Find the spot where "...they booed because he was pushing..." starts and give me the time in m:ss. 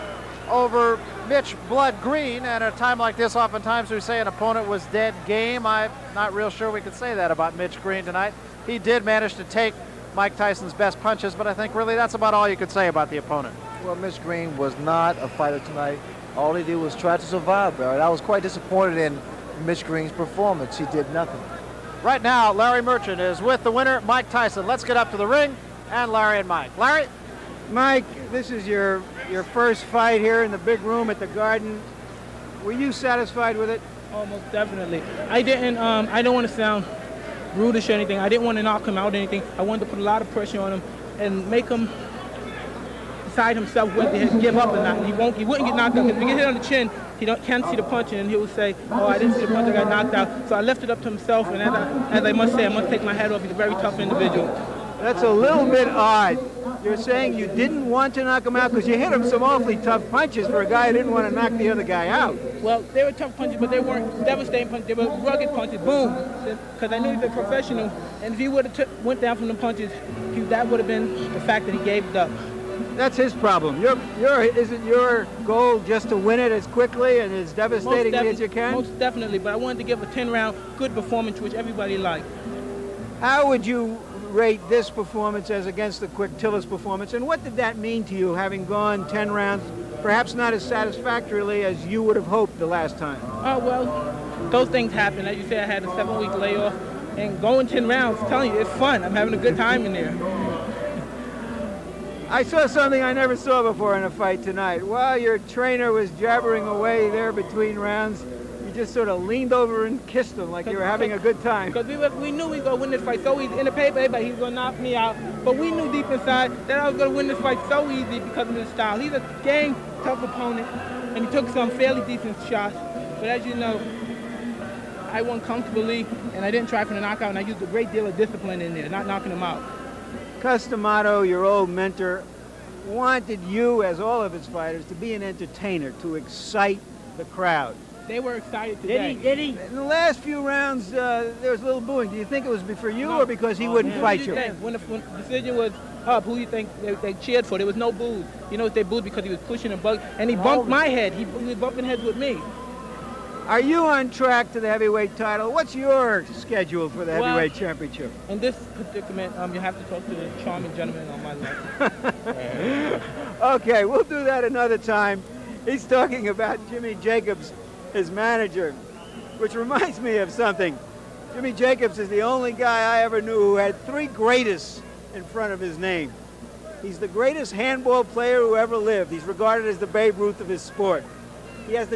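2:28.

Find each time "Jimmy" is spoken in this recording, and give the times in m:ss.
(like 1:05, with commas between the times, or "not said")
2:46, 2:51.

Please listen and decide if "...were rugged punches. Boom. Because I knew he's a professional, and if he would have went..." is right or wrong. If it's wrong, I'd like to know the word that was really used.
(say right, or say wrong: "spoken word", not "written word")
right.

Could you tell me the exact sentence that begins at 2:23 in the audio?
or because he oh, wouldn't man.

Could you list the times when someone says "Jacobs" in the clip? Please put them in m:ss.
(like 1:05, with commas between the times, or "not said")
2:47, 2:51.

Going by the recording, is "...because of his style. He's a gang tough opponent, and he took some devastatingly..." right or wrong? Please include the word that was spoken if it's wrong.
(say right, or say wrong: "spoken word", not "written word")
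wrong: "fairly", not "devastatingly".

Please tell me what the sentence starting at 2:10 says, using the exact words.
Cus D'Amato, your old mentor, wanted you, as all of his fighters, to be an entertainer, to excite the crowd.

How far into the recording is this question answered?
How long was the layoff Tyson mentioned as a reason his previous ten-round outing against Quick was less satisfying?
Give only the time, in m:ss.
1:35.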